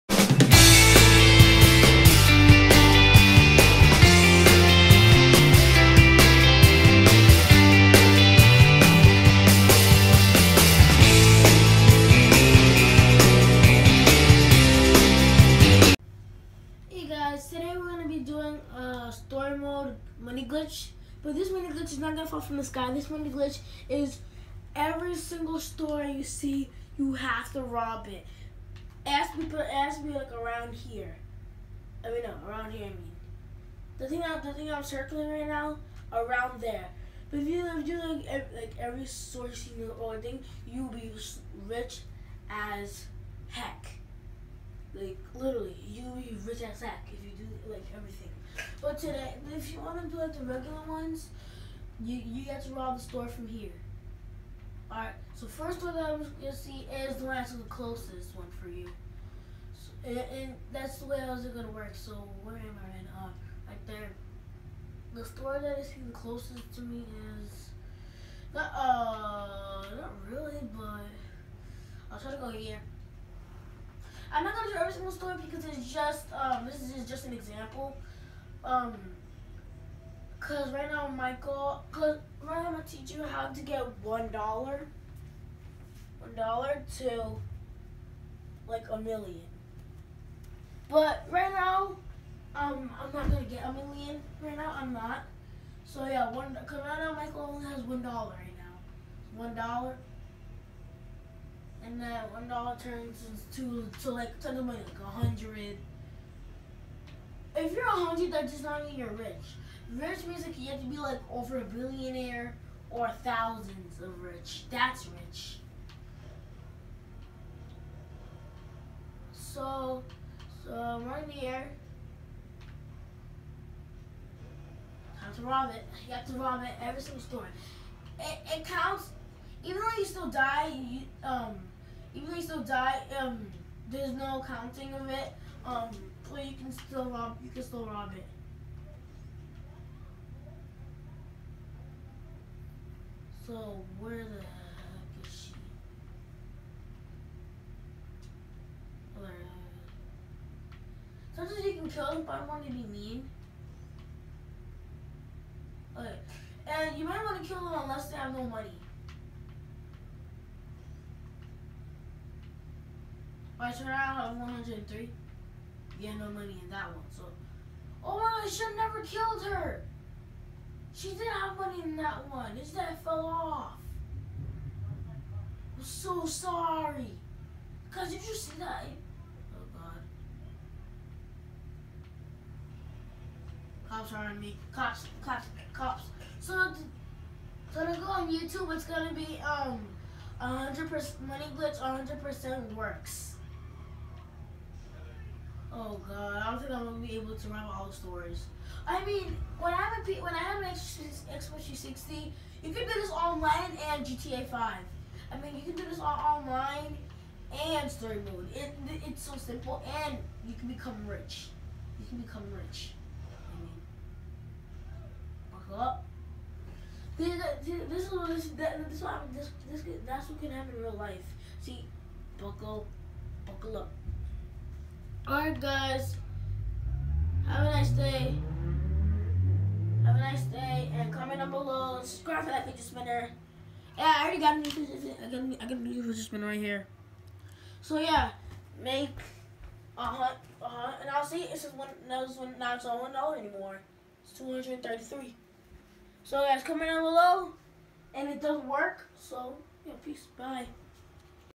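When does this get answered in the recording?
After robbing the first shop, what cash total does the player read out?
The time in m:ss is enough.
2:43.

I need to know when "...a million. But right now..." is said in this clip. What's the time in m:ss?
1:28.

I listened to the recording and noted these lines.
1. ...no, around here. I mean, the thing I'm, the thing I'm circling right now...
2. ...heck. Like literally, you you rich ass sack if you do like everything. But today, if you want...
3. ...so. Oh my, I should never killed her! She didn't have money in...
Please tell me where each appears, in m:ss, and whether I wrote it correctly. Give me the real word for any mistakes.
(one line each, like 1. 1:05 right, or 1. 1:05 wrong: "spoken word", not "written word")
1. 0:32 right
2. 0:43 right
3. 2:47 right.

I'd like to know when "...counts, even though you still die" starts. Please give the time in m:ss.
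2:08.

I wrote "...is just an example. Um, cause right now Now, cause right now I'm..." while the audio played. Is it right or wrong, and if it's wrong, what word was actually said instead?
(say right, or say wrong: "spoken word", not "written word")
wrong: "Michael", not "Now".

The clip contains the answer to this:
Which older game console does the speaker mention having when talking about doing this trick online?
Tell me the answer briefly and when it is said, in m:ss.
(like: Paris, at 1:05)
Xbox 360, at 3:20.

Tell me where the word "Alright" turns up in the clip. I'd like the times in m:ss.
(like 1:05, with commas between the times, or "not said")
3:45.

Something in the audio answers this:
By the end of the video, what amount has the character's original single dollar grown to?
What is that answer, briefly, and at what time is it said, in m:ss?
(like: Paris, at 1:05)
233, at 4:04.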